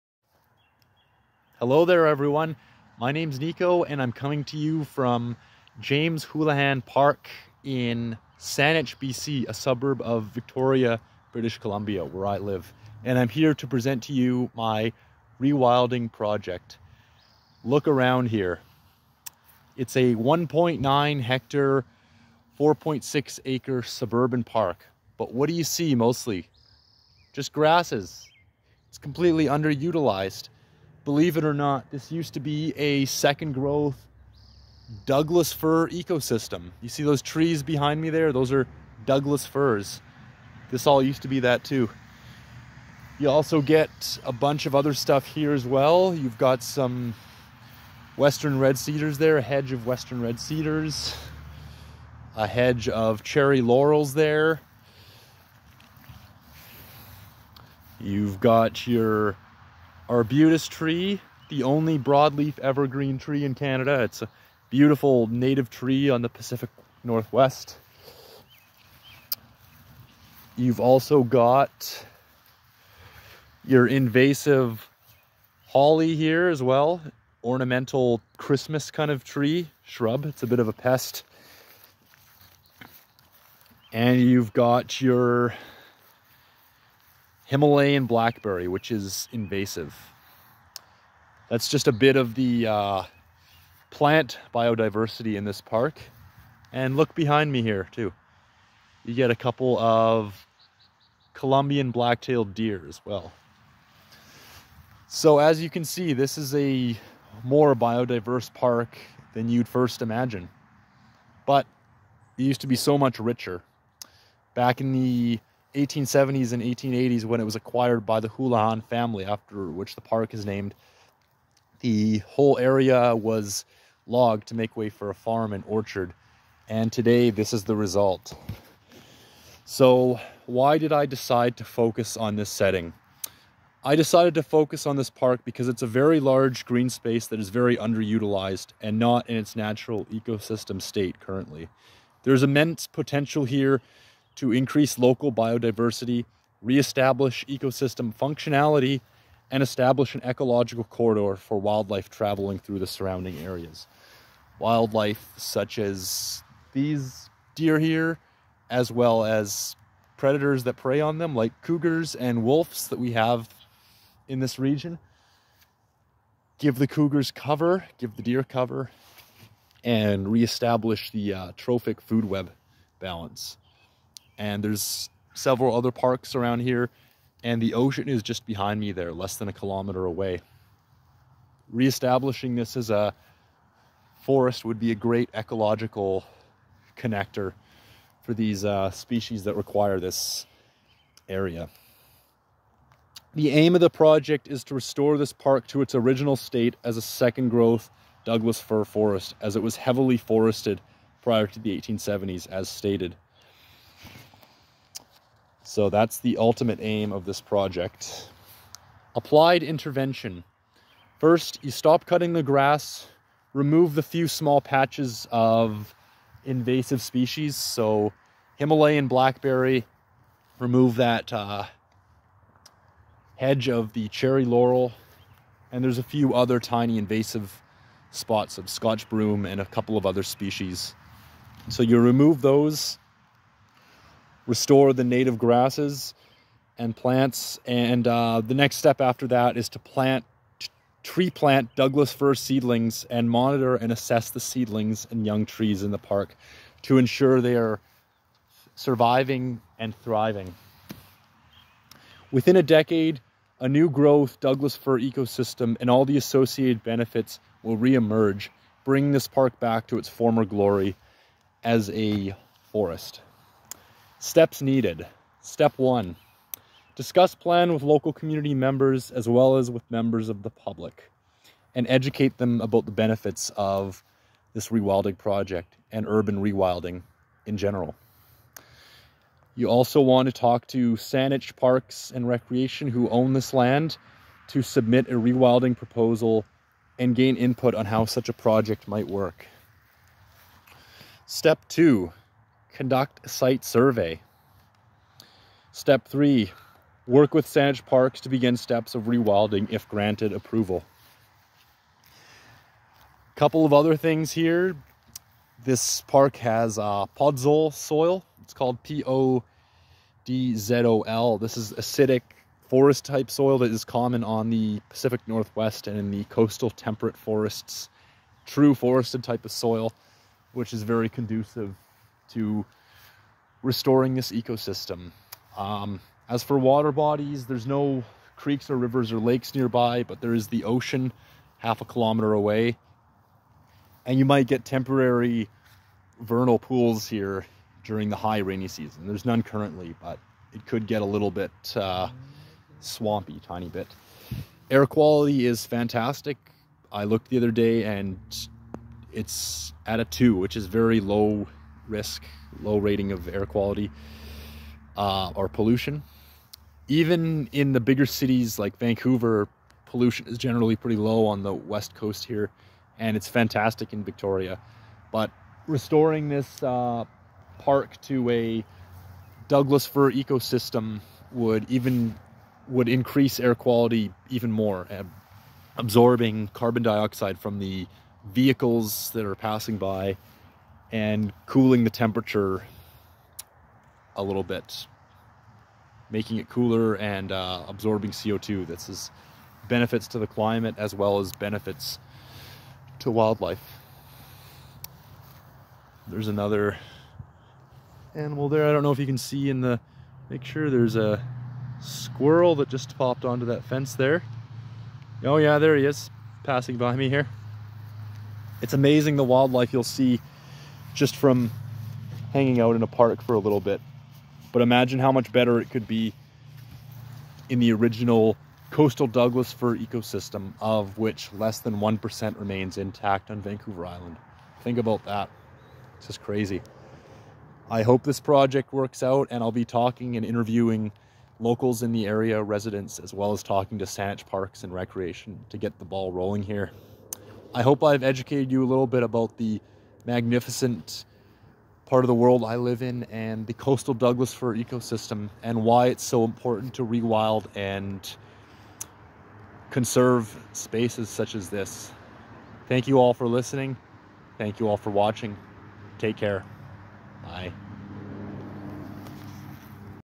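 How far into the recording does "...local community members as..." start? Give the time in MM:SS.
04:27.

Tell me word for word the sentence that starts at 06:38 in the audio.
I don't know if you can see in the Make sure There's a squirrel that just popped onto that fence there.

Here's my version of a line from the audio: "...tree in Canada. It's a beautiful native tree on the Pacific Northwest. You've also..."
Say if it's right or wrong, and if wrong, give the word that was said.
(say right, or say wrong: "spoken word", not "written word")
right.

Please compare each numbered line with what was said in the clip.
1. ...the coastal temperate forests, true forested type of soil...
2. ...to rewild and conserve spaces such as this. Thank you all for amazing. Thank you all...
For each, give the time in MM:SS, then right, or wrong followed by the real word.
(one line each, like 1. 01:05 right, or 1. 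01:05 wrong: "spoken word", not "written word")
1. 05:16 right
2. 07:26 wrong: "listening", not "amazing".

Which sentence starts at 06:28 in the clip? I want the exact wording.
This is benefits to the climate as well as benefits to wildlife.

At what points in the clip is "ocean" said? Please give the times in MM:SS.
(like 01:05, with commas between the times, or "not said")
02:57, 05:30.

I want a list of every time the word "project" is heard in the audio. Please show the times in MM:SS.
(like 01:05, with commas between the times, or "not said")
00:16, 03:13, 03:27, 04:35, 04:48, 07:08.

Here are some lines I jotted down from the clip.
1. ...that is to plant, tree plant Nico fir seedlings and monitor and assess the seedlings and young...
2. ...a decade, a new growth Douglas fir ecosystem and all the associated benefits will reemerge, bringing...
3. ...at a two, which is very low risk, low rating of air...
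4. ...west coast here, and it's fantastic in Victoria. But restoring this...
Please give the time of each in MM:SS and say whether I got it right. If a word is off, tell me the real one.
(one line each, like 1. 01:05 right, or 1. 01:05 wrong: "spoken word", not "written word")
1. 03:59 wrong: "Douglas", not "Nico"
2. 04:12 right
3. 05:49 right
4. 06:01 right.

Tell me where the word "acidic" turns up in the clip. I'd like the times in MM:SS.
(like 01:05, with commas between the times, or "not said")
05:11.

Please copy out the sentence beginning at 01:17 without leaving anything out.
Ornamental Christmas kind of tree, shrub.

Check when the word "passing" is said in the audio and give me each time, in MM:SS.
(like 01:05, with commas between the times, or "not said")
06:19, 06:46.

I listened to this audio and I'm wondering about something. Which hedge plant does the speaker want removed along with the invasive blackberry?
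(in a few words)
Cherry laurel.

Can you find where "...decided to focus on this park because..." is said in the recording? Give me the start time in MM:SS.
02:13.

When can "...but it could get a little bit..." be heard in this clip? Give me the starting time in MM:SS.
05:40.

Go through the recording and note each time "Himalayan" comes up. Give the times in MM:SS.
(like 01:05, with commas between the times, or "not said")
01:27, 03:38.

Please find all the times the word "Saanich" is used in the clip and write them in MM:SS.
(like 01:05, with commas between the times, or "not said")
00:08, 04:40, 04:57, 07:13.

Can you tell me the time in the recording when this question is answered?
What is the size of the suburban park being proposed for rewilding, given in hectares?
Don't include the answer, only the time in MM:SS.
00:20.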